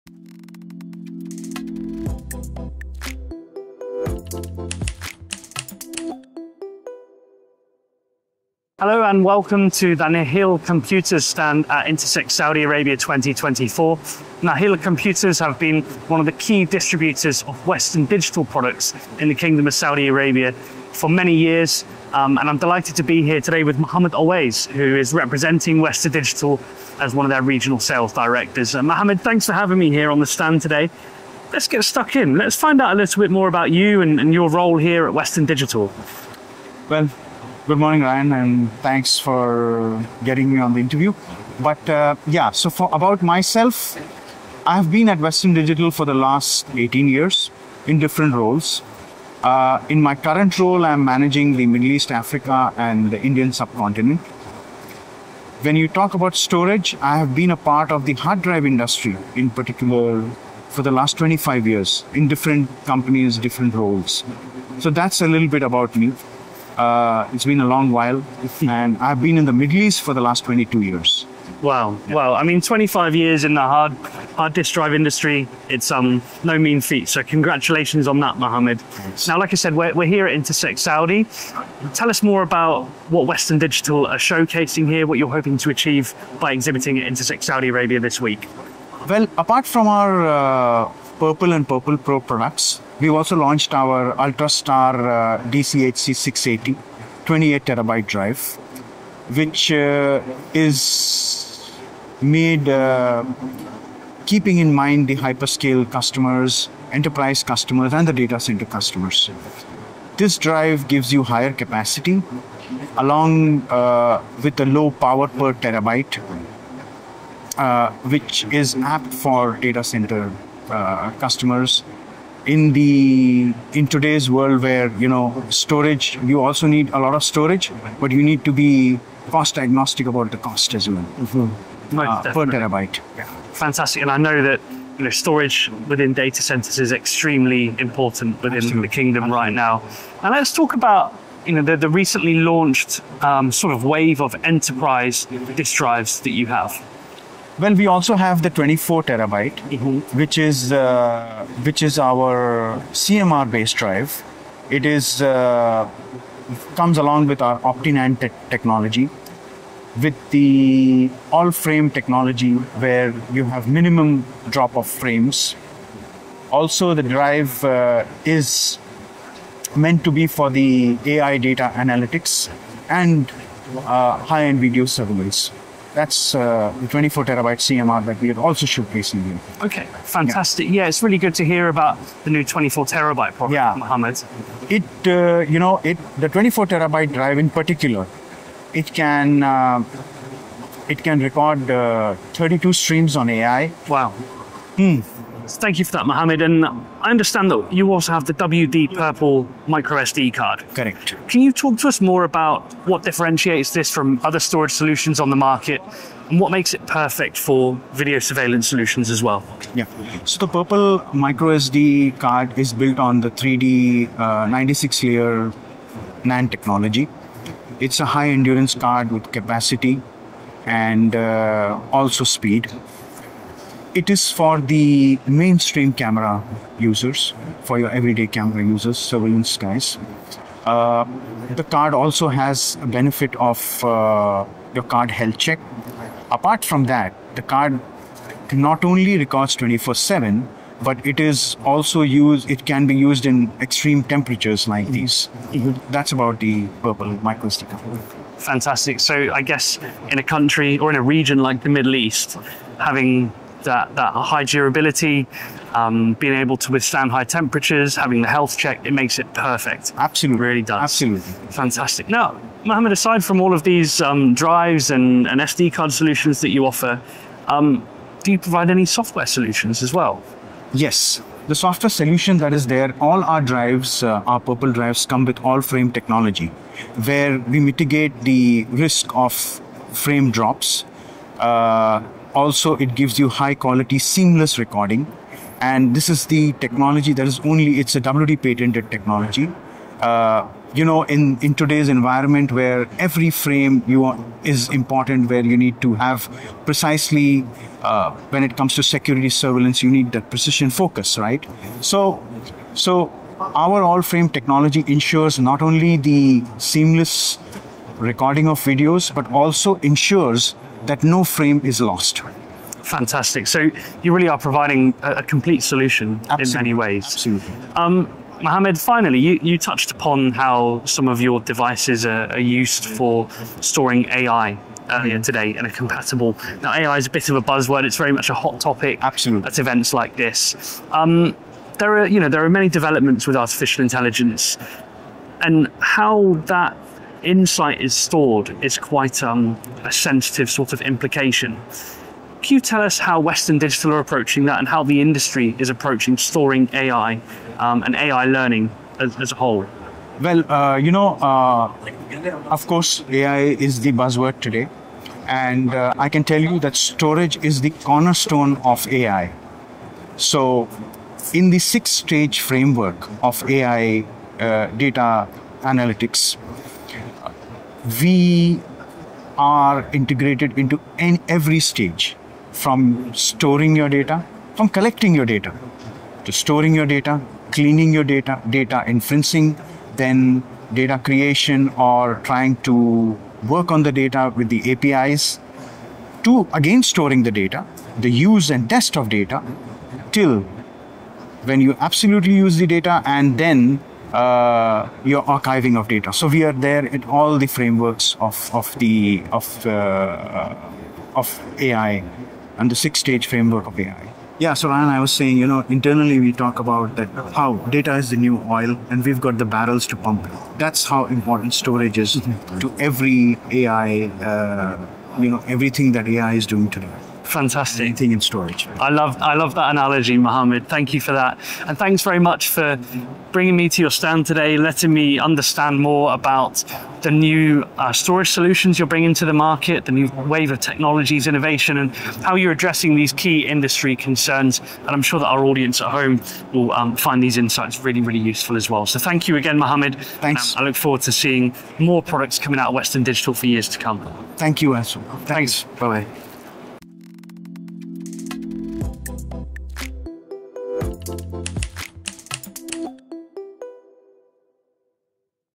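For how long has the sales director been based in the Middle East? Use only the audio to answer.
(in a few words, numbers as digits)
22 years.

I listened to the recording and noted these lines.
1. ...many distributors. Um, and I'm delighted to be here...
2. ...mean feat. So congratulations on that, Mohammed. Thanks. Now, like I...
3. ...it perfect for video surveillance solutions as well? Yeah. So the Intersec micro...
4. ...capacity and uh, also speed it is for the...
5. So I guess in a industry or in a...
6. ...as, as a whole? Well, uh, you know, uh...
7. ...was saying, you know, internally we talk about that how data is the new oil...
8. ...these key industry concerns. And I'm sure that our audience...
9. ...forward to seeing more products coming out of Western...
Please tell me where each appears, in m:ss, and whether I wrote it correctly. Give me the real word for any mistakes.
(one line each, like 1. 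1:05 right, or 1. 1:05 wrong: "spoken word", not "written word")
1. 0:21 wrong: "years", not "distributors"
2. 1:16 right
3. 3:26 wrong: "Purple", not "Intersec"
4. 3:39 right
5. 4:08 wrong: "country", not "industry"
6. 5:48 right
7. 6:44 right
8. 7:12 right
9. 7:20 right.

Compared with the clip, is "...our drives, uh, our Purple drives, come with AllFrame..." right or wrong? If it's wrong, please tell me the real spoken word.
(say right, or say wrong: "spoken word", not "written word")
right.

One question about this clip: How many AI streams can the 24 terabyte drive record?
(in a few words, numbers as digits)
32.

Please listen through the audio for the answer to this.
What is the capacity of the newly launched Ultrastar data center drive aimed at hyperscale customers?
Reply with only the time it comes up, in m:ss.
1:37.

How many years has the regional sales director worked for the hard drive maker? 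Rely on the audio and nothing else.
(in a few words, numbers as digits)
18 years.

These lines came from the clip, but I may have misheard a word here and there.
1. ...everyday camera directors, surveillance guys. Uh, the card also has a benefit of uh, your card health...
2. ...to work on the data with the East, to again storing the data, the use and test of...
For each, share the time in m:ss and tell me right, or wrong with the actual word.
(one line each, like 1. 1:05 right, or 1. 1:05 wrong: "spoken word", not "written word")
1. 3:47 wrong: "users", not "directors"
2. 6:22 wrong: "APIs", not "East".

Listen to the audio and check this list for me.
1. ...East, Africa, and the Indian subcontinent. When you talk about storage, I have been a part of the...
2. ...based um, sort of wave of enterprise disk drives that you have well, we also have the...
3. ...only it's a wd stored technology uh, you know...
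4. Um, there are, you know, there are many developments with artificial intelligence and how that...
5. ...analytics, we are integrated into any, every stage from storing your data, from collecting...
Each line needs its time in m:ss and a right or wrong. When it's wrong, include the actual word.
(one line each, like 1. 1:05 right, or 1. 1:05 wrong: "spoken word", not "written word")
1. 0:51 right
2. 2:22 wrong: "launched", not "based"
3. 4:47 wrong: "patented", not "stored"
4. 5:30 right
5. 6:05 right.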